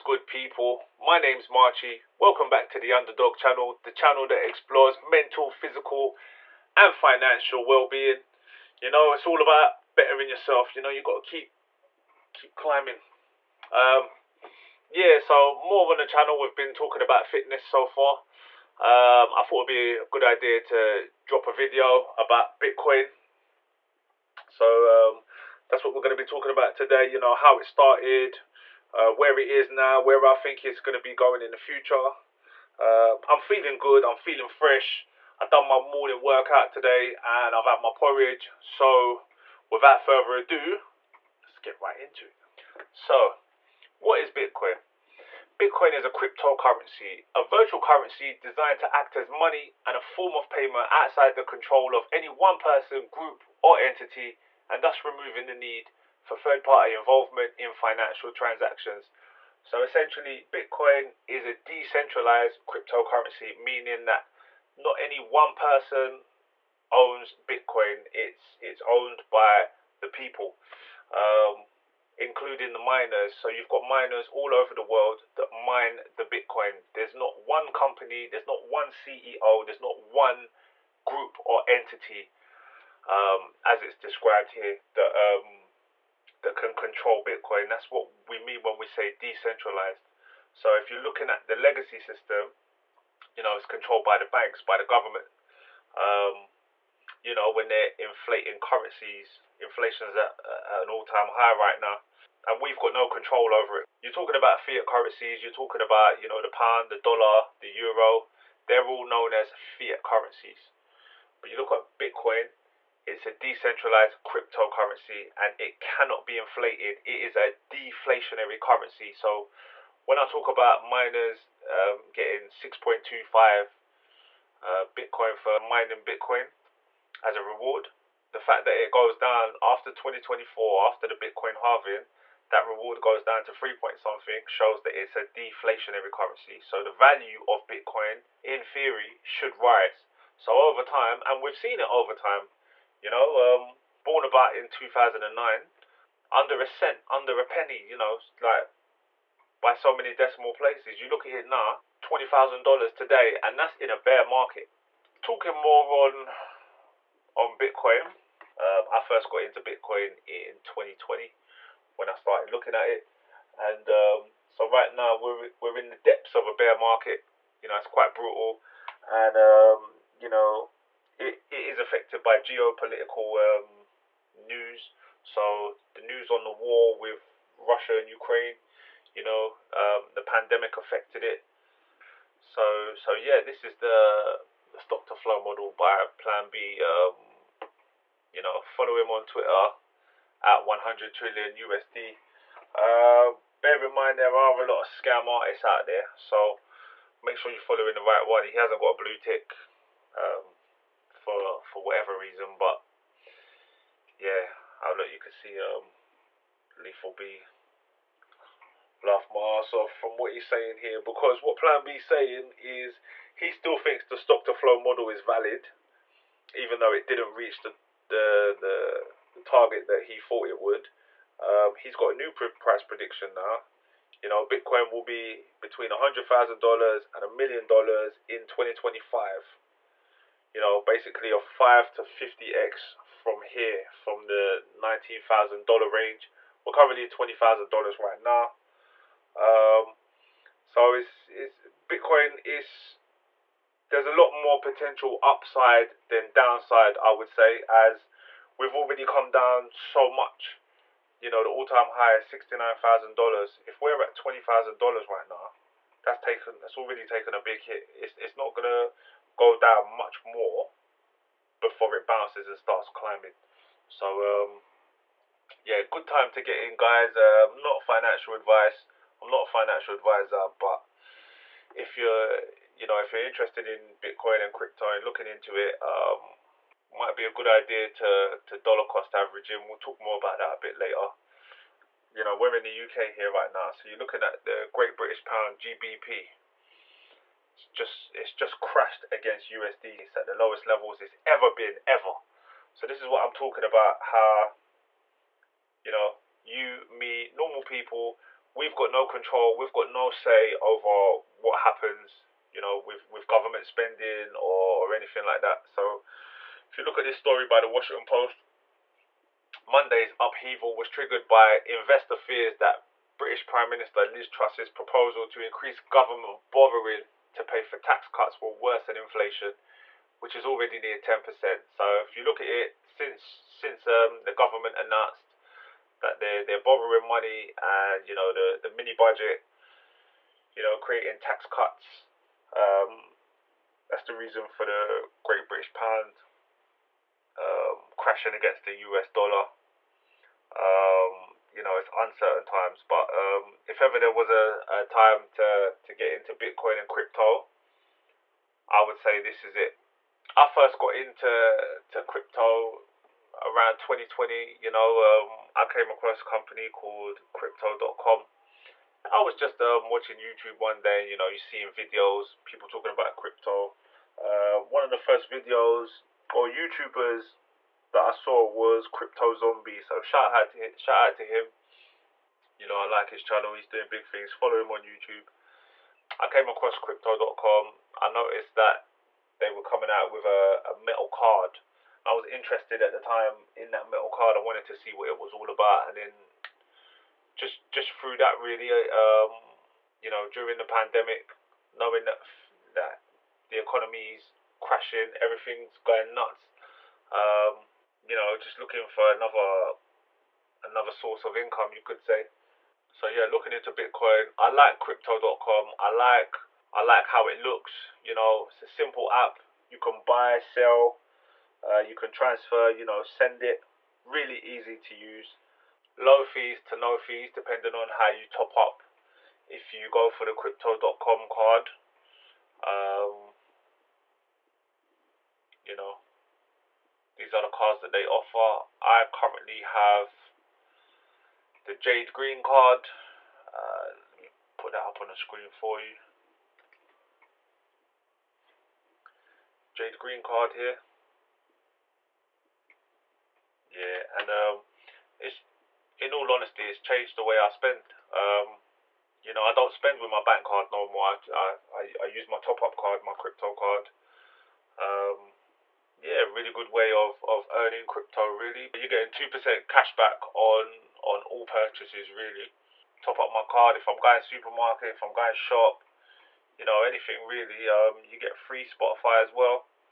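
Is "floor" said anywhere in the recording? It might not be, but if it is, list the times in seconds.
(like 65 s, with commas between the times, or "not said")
not said.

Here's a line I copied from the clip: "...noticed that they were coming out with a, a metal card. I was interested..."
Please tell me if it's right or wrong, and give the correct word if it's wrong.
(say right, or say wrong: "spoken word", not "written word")
right.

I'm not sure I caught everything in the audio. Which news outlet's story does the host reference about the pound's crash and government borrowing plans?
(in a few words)
Washington Post.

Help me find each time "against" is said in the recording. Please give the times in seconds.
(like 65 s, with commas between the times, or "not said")
289 s, 338 s.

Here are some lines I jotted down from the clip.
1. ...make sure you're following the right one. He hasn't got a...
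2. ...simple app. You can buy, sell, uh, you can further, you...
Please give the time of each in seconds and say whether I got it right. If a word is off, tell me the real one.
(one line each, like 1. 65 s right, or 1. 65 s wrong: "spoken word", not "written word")
1. 197 s right
2. 408 s wrong: "transfer", not "further".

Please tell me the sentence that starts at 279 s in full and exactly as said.
We'll talk more about that a bit later.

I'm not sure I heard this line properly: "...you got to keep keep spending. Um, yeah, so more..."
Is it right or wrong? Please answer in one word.
wrong.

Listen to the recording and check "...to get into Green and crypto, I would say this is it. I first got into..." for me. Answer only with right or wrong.
wrong.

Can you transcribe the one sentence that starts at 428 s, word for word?
I currently have the Jade Green card.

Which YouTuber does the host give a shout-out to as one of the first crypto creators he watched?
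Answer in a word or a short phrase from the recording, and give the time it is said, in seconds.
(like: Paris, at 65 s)
Crypto Zombie, at 368 s.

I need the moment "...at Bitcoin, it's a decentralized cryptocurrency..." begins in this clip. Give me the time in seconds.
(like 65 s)
111 s.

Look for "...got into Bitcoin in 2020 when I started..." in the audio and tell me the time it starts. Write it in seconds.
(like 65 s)
159 s.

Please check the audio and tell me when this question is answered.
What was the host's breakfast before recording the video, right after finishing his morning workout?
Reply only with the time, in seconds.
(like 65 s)
37 s.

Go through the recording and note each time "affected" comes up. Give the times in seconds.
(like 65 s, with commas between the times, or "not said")
171 s, 180 s.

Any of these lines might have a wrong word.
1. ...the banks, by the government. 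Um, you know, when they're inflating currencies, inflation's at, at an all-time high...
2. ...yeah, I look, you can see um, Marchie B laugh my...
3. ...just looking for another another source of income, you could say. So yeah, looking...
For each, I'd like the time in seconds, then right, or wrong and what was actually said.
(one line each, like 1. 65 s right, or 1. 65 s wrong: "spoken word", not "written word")
1. 94 s right
2. 204 s wrong: "Lethal", not "Marchie"
3. 398 s right.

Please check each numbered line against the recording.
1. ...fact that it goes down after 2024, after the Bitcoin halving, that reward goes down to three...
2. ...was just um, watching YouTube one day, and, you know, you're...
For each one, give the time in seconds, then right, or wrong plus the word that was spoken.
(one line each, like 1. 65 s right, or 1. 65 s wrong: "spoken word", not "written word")
1. 128 s right
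2. 359 s right.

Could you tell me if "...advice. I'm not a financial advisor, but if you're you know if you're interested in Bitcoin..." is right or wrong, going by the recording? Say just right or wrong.
right.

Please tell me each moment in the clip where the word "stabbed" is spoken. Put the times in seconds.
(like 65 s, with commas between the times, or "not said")
not said.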